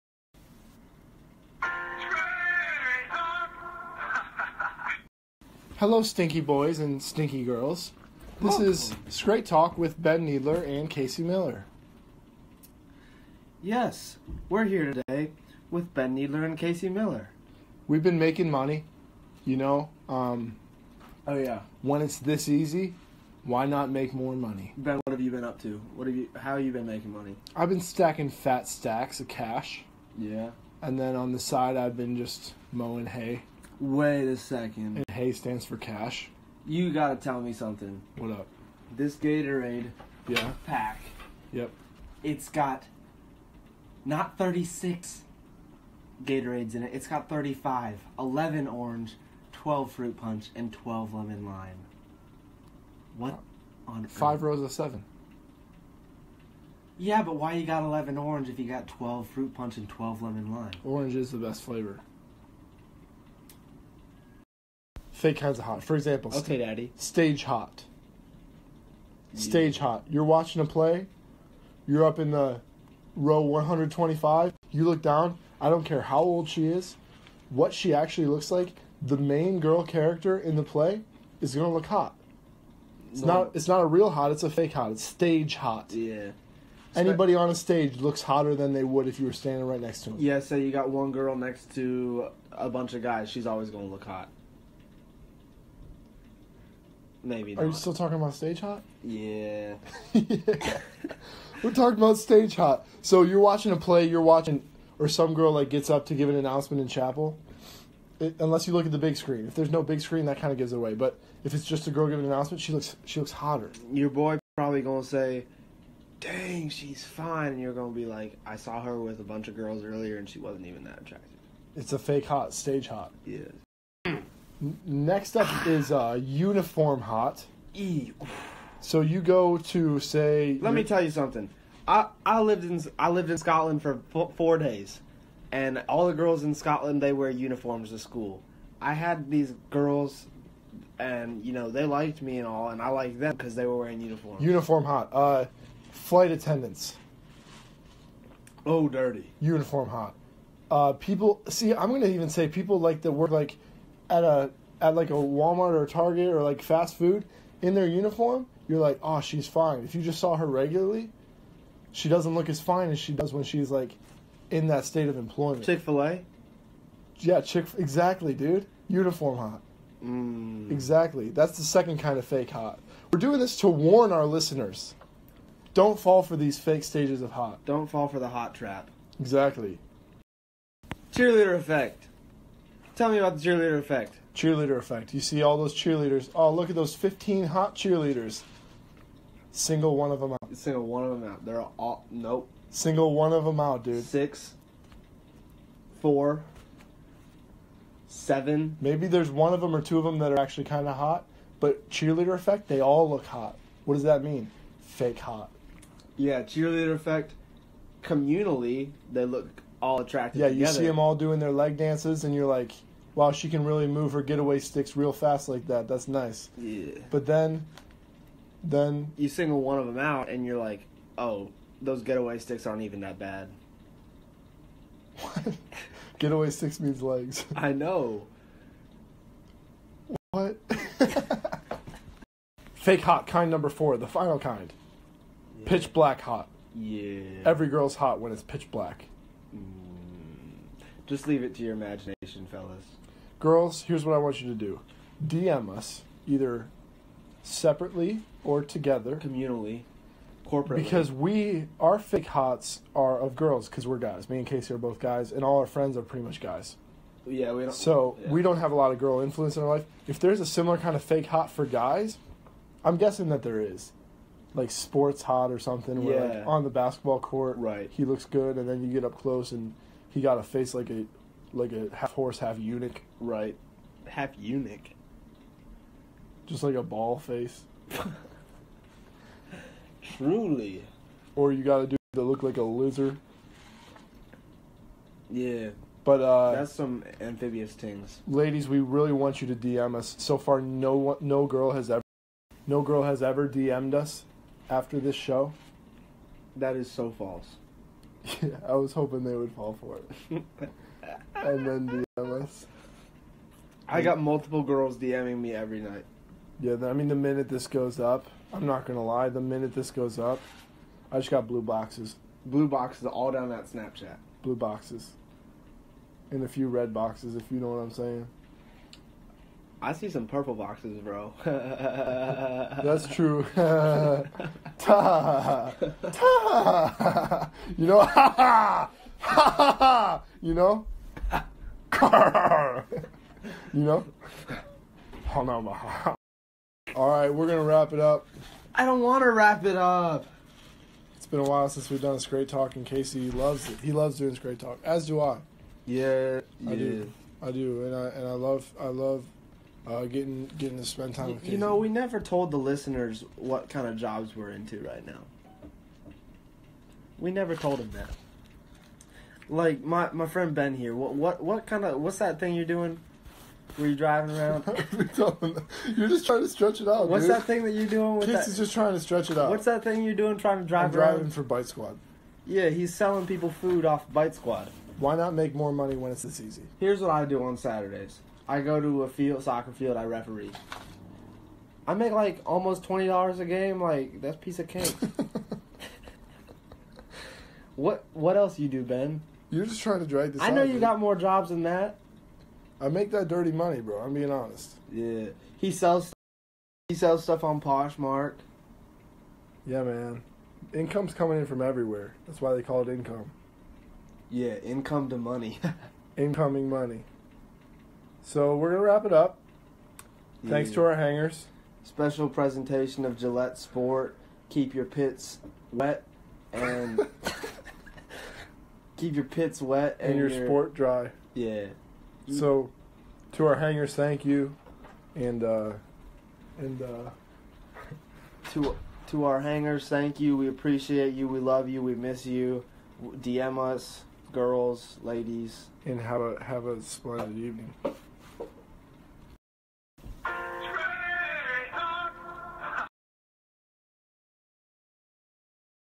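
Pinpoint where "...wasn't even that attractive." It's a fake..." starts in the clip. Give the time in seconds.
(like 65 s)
120 s.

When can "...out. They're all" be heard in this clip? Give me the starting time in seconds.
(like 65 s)
191 s.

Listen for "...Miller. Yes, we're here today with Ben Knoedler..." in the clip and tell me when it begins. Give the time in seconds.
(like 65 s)
11 s.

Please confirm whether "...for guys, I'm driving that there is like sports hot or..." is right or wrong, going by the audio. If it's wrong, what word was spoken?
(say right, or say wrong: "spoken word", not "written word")
wrong: "guessing", not "driving".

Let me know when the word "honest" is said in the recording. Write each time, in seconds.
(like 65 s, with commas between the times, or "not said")
394 s.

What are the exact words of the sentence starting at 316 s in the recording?
And a few red boxes, if you know what I'm saying.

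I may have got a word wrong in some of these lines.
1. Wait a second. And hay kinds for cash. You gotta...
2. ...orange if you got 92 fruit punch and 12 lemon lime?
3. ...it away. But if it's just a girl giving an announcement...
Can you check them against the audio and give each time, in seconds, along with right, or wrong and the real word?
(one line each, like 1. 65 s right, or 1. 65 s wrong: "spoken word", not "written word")
1. 33 s wrong: "stands", not "kinds"
2. 58 s wrong: "12", not "92"
3. 110 s right.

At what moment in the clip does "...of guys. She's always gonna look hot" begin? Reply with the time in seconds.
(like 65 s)
92 s.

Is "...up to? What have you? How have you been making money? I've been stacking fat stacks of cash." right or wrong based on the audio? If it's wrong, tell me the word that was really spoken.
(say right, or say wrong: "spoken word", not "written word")
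right.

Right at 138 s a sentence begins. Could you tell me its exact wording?
I had these girls, and you know they liked me and all, and I liked them because they were wearing uniforms.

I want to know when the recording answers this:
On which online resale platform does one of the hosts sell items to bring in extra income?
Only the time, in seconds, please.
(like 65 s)
397 s.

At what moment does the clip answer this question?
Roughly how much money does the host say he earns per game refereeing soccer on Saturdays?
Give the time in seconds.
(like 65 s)
382 s.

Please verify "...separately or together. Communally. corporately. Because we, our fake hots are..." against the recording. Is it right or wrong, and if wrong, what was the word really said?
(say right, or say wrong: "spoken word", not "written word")
right.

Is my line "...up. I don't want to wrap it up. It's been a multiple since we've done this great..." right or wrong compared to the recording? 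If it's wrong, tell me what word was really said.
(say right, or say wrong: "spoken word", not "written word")
wrong: "while", not "multiple".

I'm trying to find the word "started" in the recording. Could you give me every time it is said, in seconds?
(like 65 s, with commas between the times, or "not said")
not said.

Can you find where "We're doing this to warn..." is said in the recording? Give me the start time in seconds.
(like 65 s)
173 s.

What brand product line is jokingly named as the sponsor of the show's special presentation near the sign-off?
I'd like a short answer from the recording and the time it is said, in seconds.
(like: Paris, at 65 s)
Gillette Sport, at 413 s.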